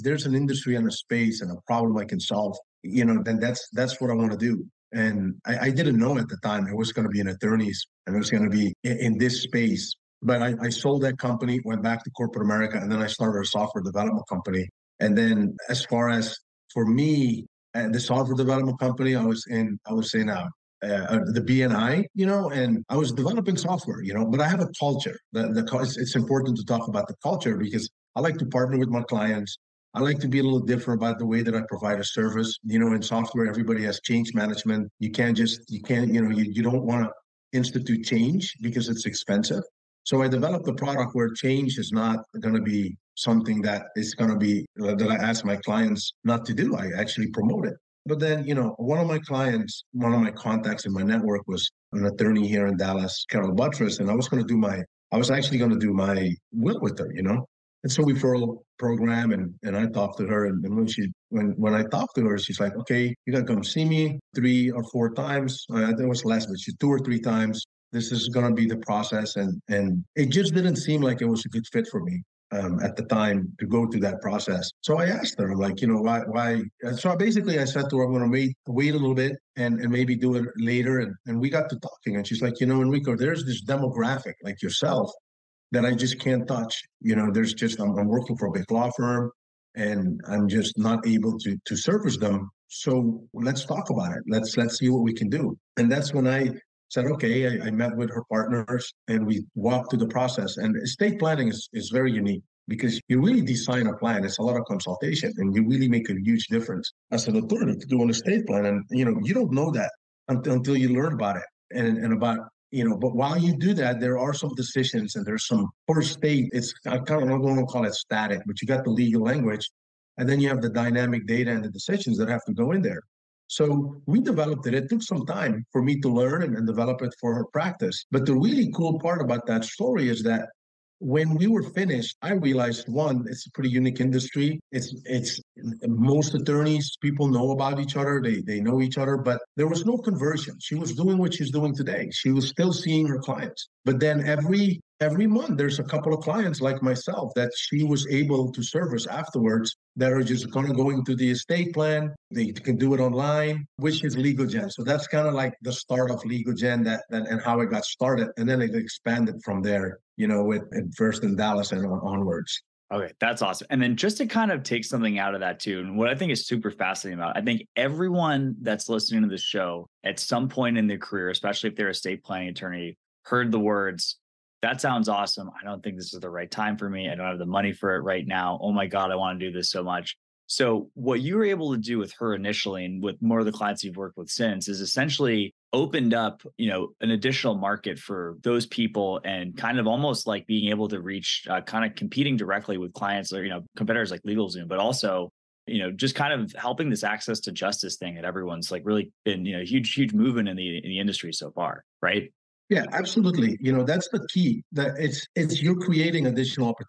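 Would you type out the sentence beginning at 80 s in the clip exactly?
And and we got to talking, and she's like, you know, Enrico, there's this demographic like yourself that I just can't touch.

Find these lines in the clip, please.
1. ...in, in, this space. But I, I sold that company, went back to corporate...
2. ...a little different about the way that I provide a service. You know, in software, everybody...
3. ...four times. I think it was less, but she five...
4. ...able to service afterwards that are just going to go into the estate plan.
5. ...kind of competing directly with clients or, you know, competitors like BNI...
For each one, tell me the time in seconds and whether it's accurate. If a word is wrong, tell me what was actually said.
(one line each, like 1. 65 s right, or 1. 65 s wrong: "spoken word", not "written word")
1. 8 s right
2. 30 s right
3. 64 s wrong: "two", not "five"
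4. 148 s right
5. 191 s wrong: "LegalZoom", not "BNI".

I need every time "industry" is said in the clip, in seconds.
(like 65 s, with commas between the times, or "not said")
0 s, 133 s, 200 s.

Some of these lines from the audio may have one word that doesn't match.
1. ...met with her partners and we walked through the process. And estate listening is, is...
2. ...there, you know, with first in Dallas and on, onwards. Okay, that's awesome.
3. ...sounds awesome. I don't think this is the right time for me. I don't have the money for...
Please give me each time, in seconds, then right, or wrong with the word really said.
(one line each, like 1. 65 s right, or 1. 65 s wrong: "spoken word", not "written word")
1. 97 s wrong: "planning", not "listening"
2. 159 s right
3. 174 s right.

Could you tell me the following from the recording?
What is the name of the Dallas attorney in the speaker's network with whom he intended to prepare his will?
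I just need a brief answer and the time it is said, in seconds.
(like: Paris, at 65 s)
Carol Buttress, at 53 s.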